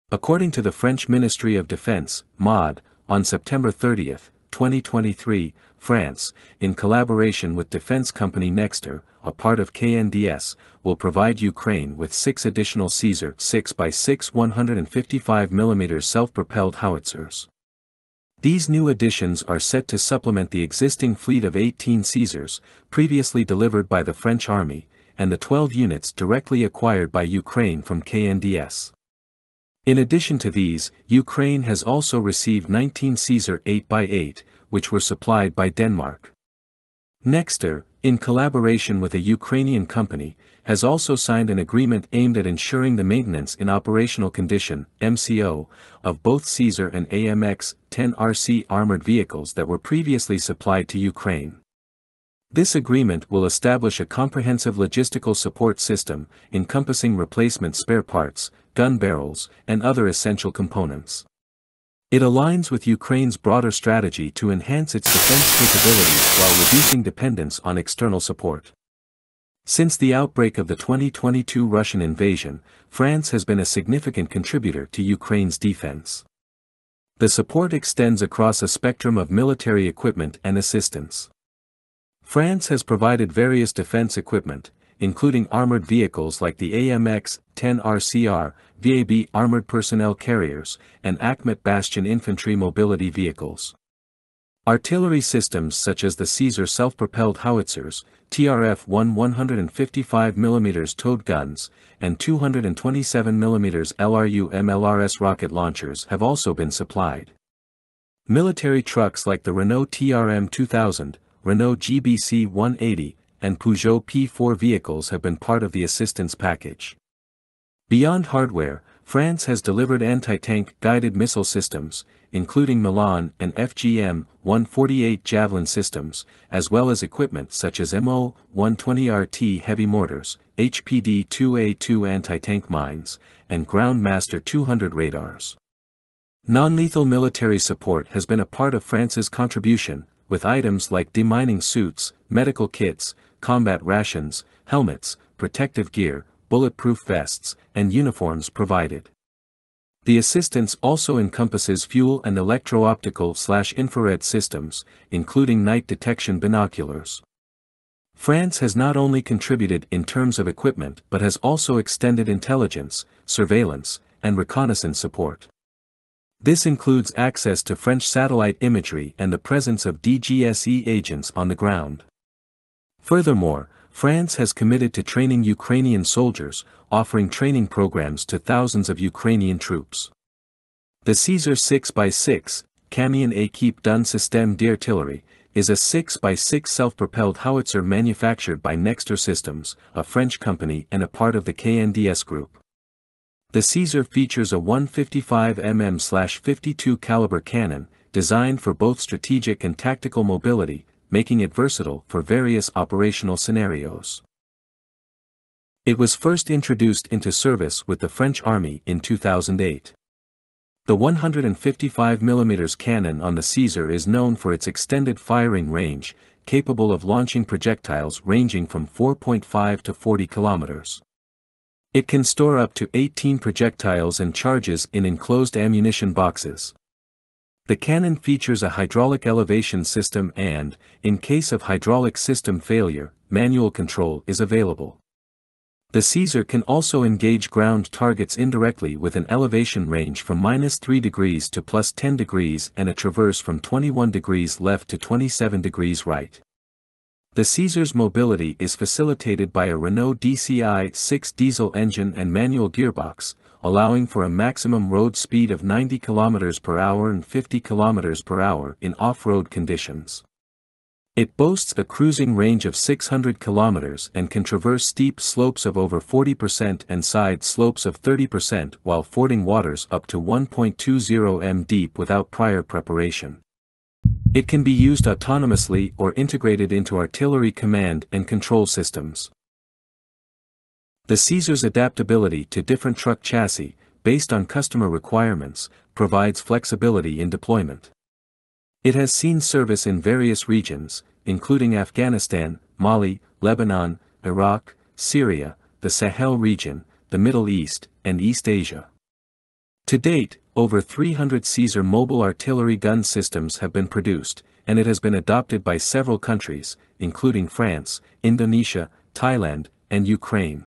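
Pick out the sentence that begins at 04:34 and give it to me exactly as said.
It can be used autonomously or integrated into artillery command and control systems.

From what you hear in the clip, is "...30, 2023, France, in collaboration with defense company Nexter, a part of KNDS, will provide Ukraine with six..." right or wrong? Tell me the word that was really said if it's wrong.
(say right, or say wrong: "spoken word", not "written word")
right.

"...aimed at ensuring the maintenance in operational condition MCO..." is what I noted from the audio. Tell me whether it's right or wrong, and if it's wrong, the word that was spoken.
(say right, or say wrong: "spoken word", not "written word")
right.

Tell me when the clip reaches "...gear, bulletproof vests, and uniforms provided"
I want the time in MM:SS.
02:25.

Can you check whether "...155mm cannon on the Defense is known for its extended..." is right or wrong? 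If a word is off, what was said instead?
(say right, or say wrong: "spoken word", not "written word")
wrong: "Caesar", not "Defense".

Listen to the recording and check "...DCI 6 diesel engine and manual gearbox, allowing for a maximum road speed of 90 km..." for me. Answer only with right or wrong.
right.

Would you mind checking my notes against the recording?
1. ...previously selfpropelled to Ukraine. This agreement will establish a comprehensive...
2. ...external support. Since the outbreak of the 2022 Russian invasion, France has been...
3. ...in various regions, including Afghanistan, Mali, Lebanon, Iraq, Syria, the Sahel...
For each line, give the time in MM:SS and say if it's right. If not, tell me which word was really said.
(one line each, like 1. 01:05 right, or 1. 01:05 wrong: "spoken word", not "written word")
1. 00:49 wrong: "supplied", not "selfpropelled"
2. 01:07 right
3. 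04:49 right.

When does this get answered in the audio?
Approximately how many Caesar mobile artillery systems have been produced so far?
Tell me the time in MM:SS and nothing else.
05:00.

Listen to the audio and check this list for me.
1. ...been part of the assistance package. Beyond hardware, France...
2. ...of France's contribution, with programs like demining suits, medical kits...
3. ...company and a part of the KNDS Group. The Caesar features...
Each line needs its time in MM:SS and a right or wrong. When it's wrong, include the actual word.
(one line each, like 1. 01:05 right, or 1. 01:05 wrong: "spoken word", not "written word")
1. 01:55 right
2. 02:18 wrong: "items", not "programs"
3. 03:10 right.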